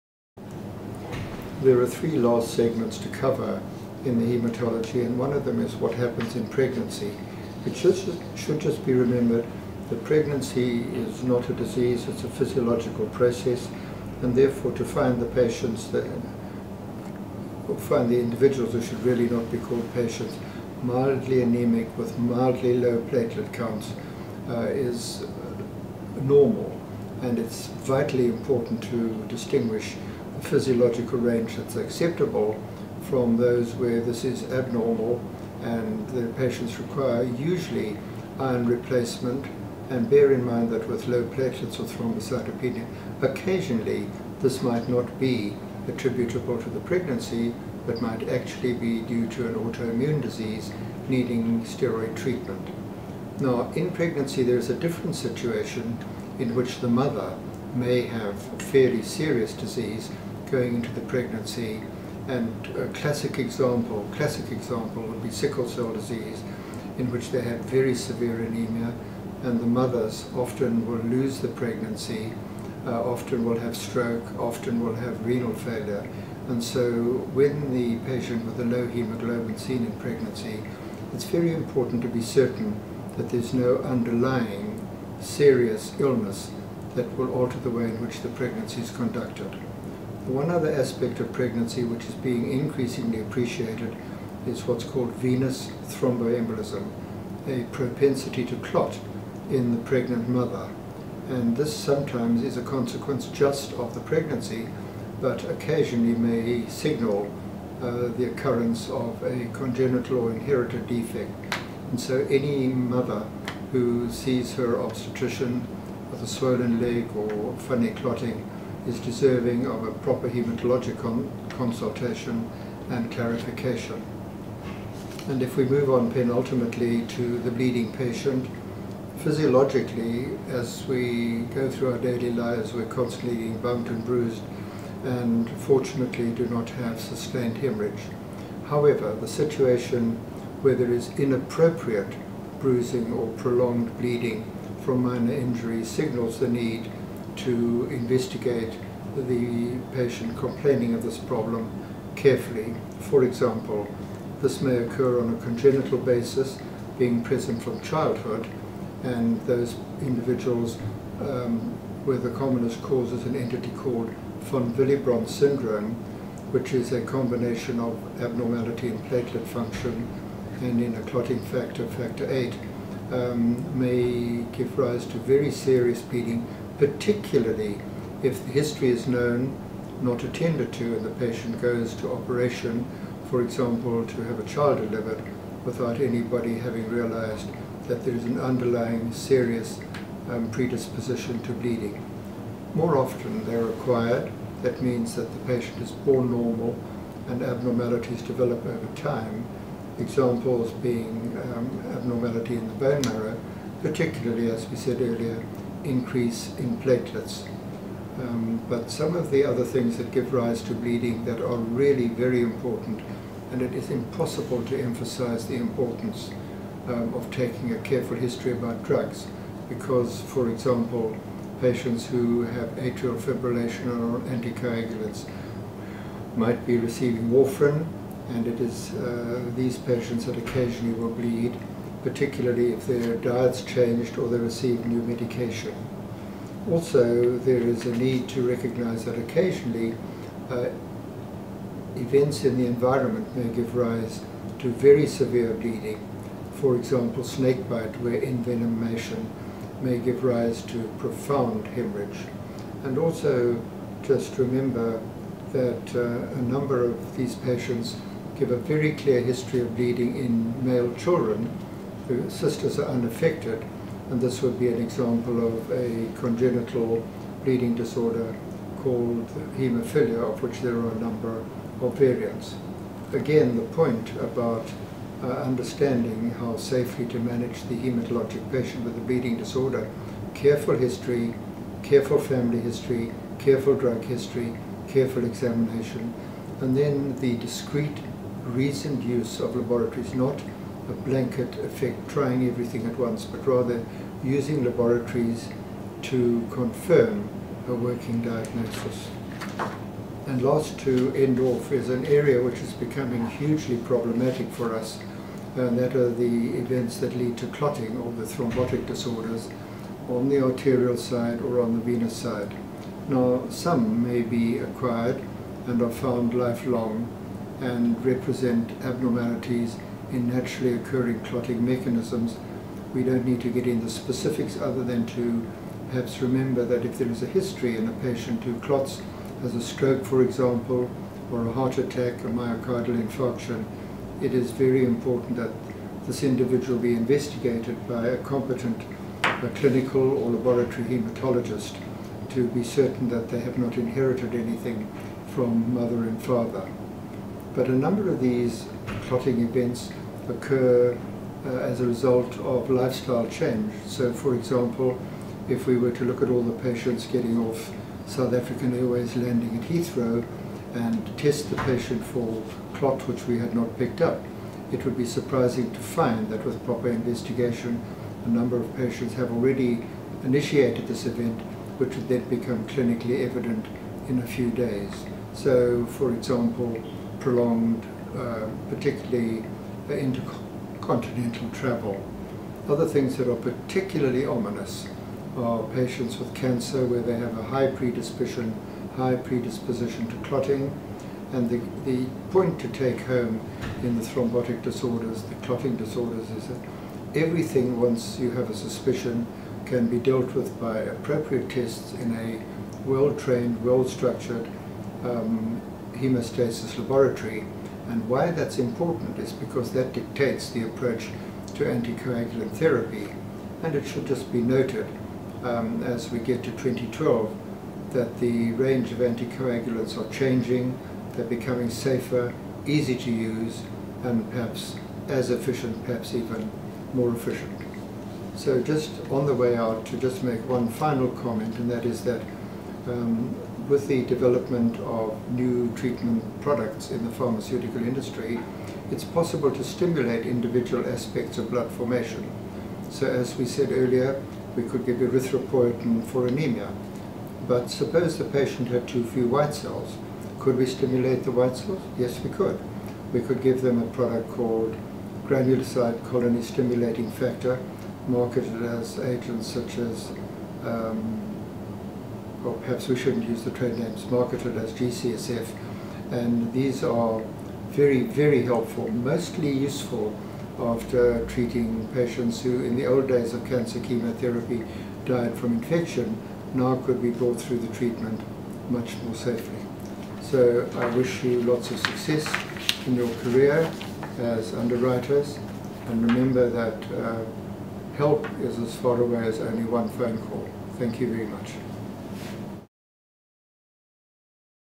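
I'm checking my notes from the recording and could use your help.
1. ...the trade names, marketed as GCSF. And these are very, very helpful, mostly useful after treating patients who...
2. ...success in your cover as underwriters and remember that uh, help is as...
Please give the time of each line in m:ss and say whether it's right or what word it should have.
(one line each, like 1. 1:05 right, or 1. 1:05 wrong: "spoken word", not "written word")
1. 7:43 right
2. 8:01 wrong: "career", not "cover".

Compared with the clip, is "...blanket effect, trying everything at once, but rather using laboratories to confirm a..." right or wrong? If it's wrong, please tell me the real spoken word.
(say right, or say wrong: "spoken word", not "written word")
right.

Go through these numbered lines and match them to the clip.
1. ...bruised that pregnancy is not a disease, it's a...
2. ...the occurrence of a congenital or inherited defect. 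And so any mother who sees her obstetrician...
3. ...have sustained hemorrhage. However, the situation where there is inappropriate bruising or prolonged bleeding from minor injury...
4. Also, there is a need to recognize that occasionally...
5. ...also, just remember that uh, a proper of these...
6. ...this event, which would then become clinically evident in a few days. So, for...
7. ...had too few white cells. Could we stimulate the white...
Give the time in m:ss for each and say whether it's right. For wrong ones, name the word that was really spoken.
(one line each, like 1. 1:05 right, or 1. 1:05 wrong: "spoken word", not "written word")
1. 0:08 wrong: "remembered", not "bruised"
2. 1:48 right
3. 2:16 right
4. 3:56 right
5. 4:12 wrong: "number", not "proper"
6. 6:10 right
7. 7:28 right.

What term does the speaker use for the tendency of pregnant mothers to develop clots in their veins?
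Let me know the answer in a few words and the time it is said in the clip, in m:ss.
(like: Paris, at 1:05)
Venous thromboembolism, at 1:35.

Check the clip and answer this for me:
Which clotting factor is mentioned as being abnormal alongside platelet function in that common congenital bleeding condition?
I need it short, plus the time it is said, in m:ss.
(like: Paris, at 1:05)
Factor 8, at 2:51.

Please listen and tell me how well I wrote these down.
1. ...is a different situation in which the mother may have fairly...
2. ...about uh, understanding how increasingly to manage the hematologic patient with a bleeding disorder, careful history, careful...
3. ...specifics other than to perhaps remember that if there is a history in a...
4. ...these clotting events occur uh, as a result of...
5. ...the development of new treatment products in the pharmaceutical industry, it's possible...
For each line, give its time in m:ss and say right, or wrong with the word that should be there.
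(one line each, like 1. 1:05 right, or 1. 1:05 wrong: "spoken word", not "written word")
1. 0:54 right
2. 4:34 wrong: "safely", not "increasingly"
3. 5:23 right
4. 5:48 right
5. 7:13 right.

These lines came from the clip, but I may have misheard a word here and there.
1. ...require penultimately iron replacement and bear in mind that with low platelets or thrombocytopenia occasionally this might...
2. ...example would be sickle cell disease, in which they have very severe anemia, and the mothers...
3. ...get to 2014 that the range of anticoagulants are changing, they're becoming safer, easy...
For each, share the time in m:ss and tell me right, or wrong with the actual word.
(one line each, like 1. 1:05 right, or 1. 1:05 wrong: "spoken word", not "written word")
1. 0:36 wrong: "usually", not "penultimately"
2. 1:04 right
3. 6:56 wrong: "2012", not "2014".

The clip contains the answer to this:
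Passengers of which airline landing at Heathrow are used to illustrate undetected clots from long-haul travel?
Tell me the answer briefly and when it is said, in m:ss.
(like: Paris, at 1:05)
South African Airways, at 5:58.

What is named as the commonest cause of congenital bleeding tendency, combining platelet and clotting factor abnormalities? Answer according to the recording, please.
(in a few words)
von Willebrand syndrome.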